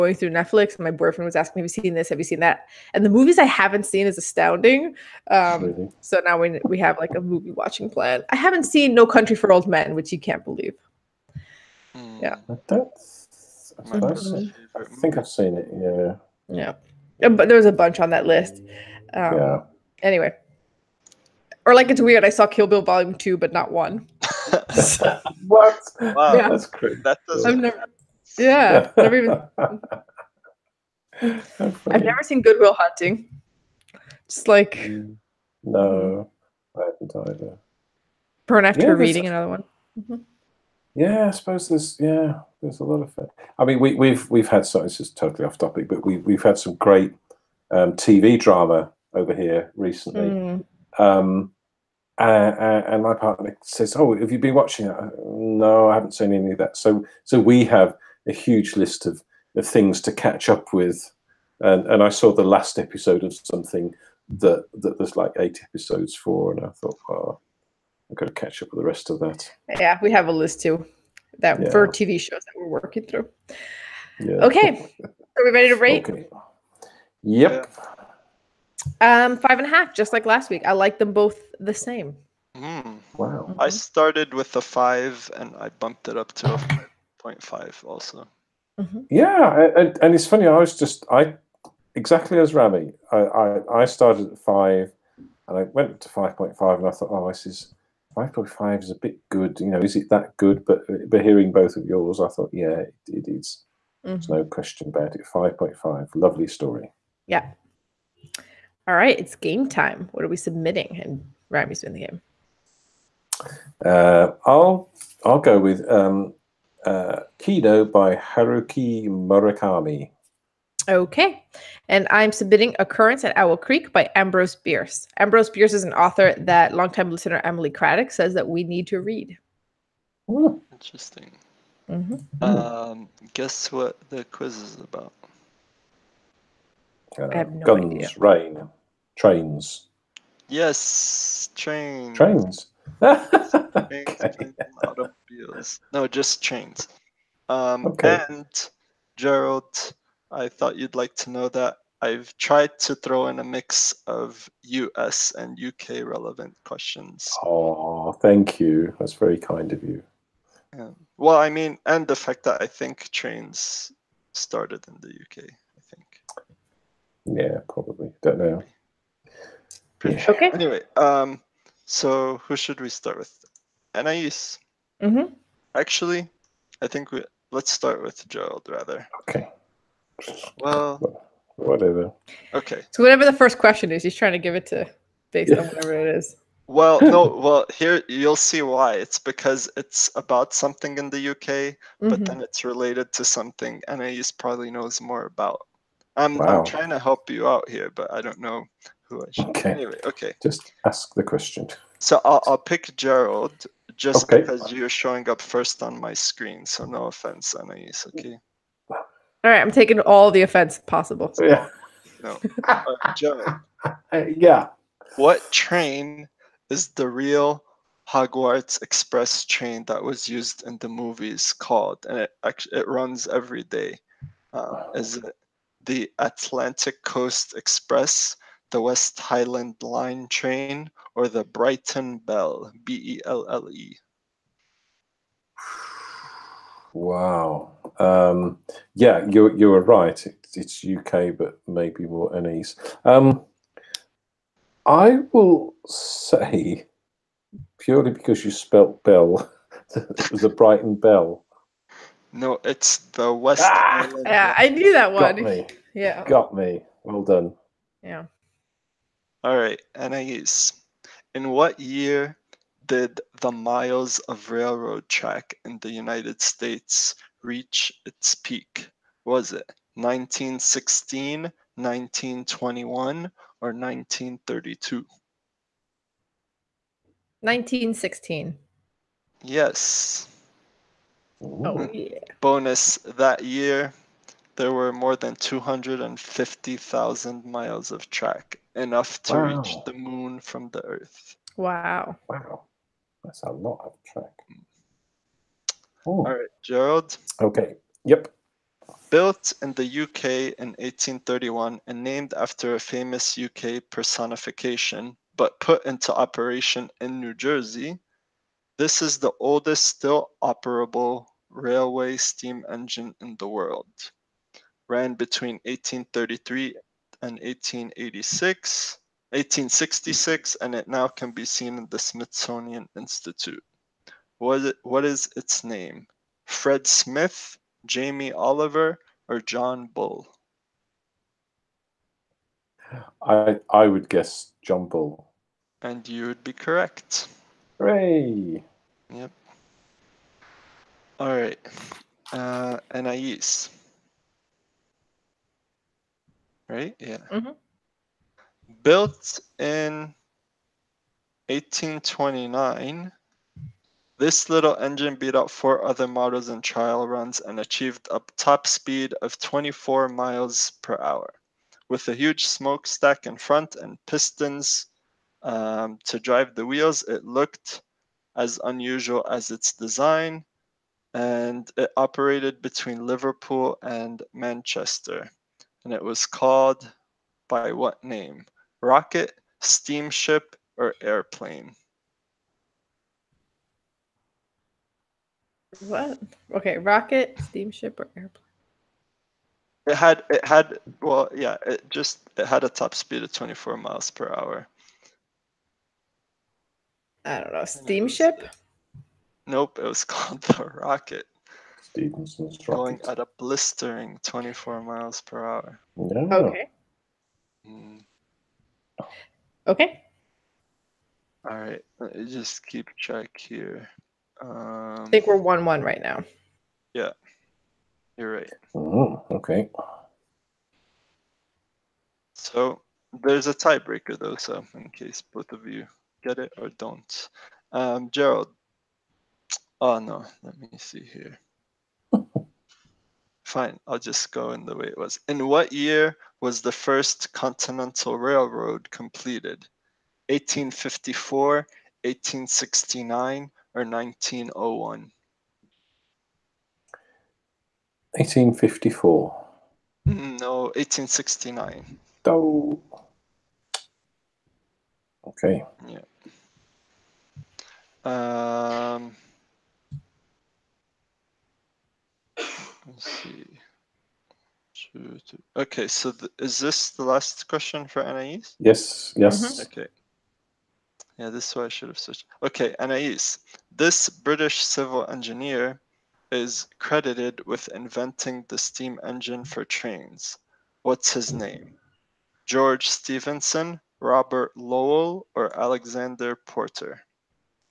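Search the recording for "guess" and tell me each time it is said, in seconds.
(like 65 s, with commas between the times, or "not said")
133 s, 334 s.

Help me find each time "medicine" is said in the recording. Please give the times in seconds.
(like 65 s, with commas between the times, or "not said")
not said.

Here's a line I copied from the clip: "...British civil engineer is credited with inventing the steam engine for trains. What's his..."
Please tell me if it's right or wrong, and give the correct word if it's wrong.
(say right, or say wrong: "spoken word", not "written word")
right.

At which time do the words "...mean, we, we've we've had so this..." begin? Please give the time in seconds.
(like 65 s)
43 s.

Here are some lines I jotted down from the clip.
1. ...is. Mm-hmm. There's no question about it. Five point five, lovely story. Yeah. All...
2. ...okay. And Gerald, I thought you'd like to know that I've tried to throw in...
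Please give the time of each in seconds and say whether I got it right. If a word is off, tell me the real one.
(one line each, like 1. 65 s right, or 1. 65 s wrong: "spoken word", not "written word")
1. 103 s right
2. 147 s right.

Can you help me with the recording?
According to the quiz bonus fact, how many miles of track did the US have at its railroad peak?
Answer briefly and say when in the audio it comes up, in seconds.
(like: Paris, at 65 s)
250,000, at 285 s.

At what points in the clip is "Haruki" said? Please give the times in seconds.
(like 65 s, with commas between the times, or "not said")
118 s.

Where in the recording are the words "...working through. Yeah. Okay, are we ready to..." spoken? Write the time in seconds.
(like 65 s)
72 s.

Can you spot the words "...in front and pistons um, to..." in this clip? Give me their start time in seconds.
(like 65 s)
363 s.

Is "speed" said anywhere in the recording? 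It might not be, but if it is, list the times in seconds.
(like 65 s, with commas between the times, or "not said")
358 s, 392 s.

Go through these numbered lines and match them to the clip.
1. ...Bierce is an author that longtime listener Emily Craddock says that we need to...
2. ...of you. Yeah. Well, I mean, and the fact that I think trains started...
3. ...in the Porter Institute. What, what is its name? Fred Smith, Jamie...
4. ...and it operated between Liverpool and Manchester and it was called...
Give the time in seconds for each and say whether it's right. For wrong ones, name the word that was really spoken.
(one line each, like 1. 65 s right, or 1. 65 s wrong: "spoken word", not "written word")
1. 125 s right
2. 159 s right
3. 321 s wrong: "Smithsonian", not "Porter"
4. 371 s right.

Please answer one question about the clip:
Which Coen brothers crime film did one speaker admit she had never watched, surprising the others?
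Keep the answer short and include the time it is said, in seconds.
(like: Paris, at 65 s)
No Country for Old Men, at 8 s.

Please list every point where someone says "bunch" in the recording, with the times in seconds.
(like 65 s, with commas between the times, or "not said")
17 s.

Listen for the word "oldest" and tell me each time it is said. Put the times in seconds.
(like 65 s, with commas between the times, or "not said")
309 s.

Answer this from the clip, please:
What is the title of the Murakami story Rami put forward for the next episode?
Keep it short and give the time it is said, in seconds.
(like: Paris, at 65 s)
Kino, at 117 s.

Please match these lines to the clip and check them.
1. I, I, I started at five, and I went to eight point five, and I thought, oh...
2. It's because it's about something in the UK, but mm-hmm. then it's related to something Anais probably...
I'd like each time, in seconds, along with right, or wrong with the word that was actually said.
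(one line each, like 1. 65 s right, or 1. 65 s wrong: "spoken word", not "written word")
1. 93 s wrong: "five", not "eight"
2. 188 s right.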